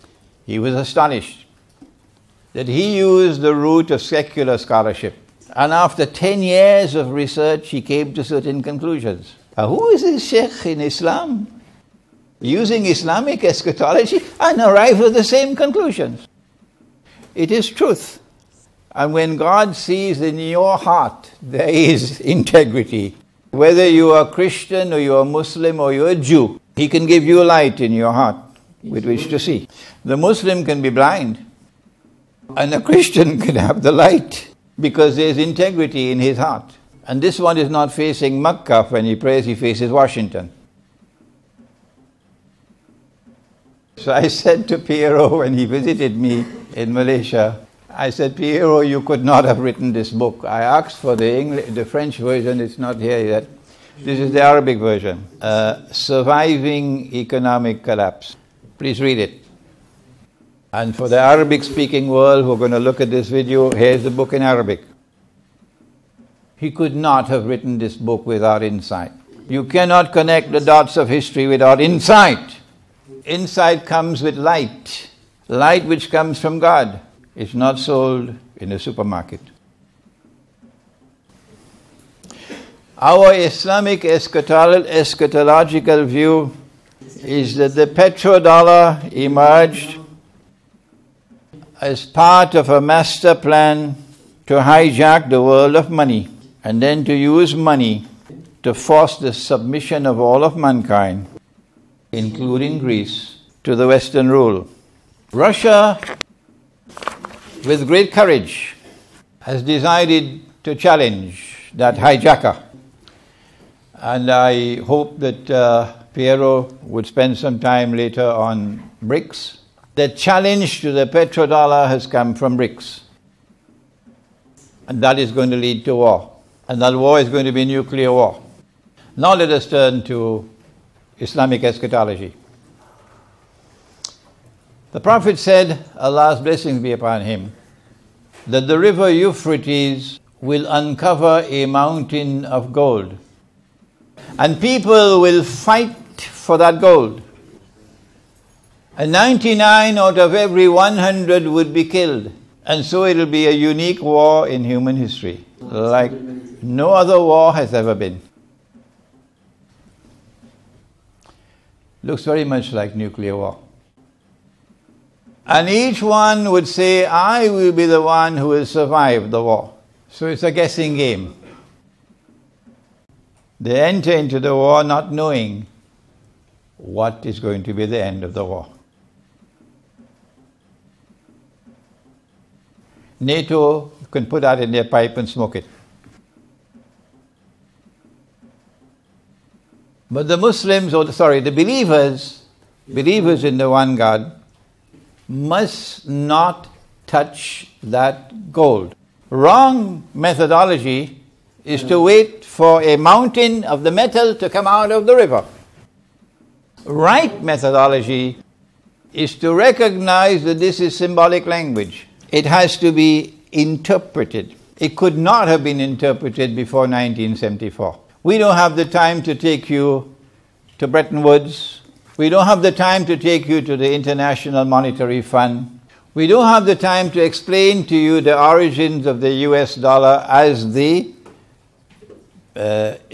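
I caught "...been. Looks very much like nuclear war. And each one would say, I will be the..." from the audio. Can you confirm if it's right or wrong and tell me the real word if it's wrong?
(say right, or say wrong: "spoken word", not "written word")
right.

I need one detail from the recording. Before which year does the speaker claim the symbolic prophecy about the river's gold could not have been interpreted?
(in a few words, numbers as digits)
1974.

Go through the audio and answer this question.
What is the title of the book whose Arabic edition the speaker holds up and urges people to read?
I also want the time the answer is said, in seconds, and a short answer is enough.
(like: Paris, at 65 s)
Surviving Economic Collapse, at 55 s.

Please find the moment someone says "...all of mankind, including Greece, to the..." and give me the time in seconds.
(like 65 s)
100 s.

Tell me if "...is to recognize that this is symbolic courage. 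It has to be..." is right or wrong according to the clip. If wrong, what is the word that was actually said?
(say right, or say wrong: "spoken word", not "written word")
wrong: "language", not "courage".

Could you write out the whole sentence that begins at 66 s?
He could not have written this book without insight.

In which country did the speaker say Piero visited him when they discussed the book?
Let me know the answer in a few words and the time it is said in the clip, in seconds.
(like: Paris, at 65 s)
Malaysia, at 46 s.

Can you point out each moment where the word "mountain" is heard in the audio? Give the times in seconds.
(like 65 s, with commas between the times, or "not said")
141 s, 202 s.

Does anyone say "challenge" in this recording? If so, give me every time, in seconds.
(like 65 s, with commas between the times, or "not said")
110 s, 120 s.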